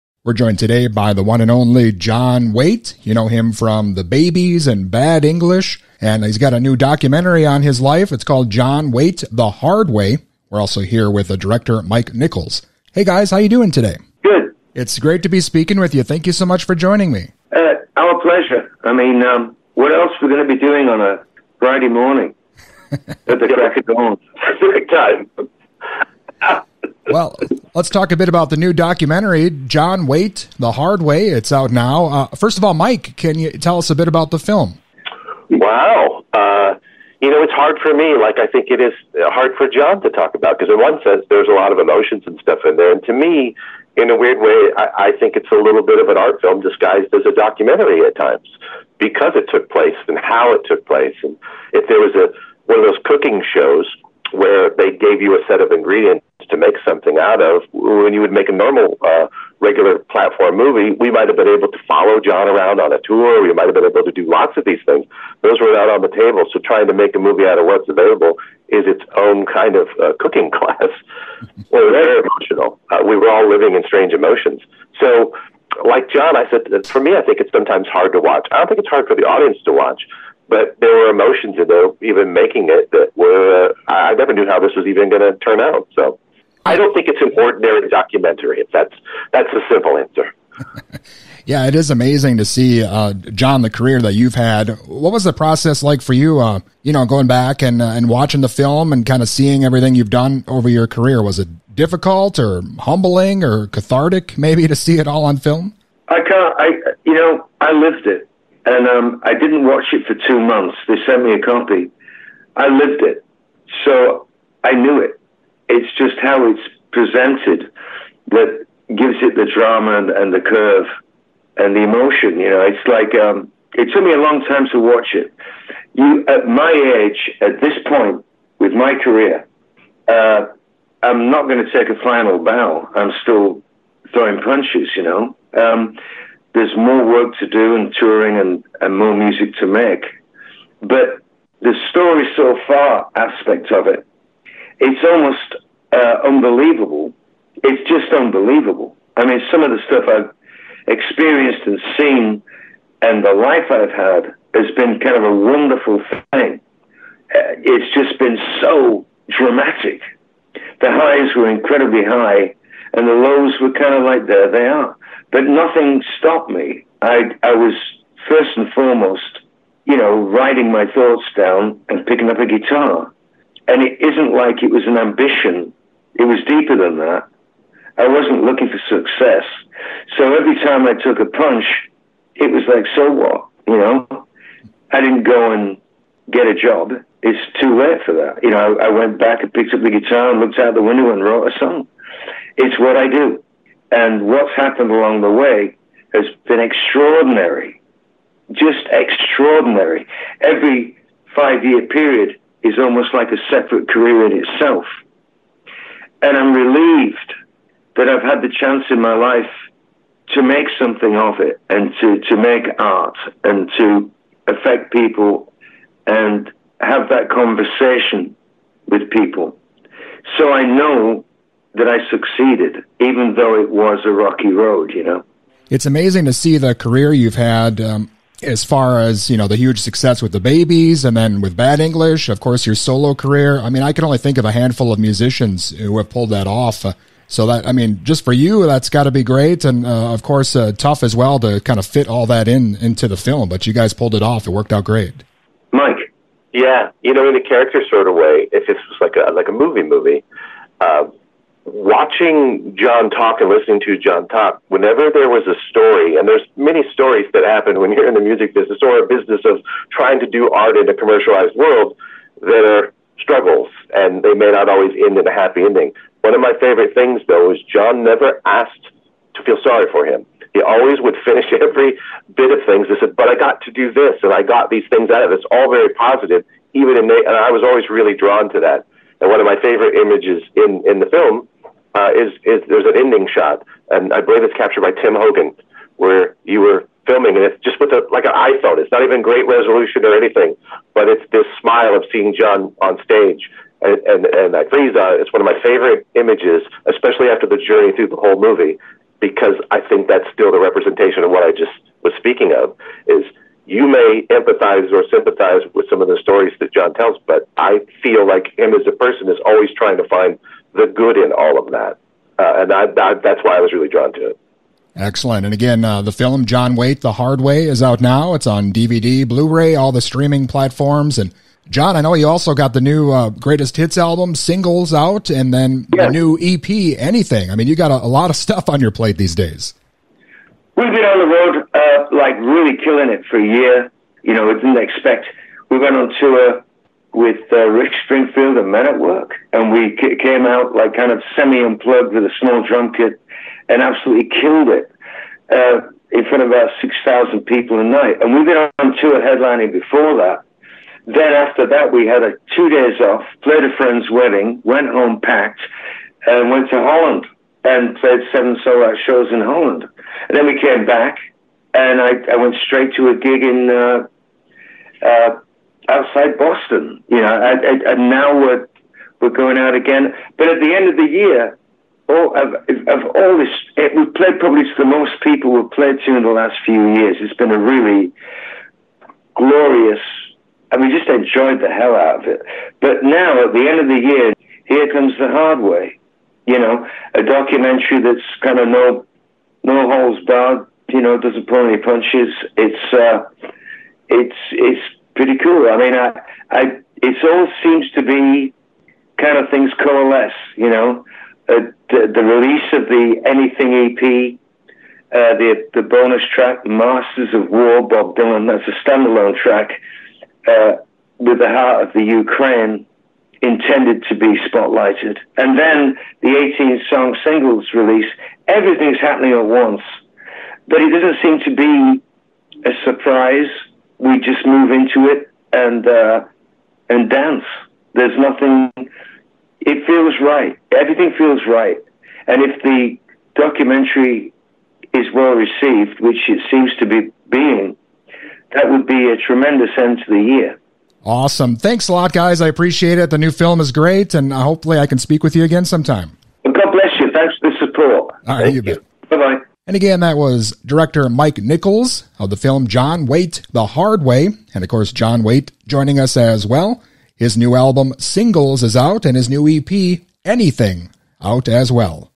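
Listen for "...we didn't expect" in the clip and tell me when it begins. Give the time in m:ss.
5:34.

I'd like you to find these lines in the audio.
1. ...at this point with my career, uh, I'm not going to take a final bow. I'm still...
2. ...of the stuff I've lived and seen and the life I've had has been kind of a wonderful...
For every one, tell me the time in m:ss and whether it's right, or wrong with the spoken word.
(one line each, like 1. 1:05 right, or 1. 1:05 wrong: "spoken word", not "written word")
1. 2:07 right
2. 2:29 wrong: "experienced", not "lived".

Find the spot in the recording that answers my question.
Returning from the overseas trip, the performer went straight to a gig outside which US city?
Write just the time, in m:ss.
6:06.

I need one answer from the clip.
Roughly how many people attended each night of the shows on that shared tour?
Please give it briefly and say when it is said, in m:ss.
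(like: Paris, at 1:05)
6000, at 5:46.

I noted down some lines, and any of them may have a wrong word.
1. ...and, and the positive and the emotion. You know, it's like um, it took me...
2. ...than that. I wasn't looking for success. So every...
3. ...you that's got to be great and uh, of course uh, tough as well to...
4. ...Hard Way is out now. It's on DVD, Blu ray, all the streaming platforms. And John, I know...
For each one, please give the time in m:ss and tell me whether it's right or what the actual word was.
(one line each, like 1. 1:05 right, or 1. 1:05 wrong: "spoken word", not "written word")
1. 1:59 wrong: "curve", not "positive"
2. 2:56 right
3. 3:58 right
4. 5:17 right.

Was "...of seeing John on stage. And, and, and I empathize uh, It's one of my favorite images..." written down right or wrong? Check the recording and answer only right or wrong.
wrong.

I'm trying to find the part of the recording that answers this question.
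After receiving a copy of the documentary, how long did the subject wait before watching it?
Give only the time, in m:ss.
1:50.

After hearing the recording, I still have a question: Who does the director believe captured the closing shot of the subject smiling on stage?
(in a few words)
Tim Hogan.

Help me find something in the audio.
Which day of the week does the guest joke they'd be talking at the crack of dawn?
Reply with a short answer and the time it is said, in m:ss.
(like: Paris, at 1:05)
Friday, at 0:21.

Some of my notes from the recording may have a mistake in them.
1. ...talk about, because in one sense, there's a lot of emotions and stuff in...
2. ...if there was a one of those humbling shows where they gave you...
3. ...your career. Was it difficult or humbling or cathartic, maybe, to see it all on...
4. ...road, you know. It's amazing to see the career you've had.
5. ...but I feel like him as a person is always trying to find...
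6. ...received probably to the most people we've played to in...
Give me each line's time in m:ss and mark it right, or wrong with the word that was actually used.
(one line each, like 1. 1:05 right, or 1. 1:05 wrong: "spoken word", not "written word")
1. 0:40 right
2. 0:51 wrong: "cooking", not "humbling"
3. 1:40 right
4. 3:44 right
5. 5:07 right
6. 6:14 wrong: "played", not "received".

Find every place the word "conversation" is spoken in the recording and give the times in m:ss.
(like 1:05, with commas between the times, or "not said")
3:37.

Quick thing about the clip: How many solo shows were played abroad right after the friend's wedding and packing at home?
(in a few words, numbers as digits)
7.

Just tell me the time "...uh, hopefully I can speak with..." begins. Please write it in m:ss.
7:24.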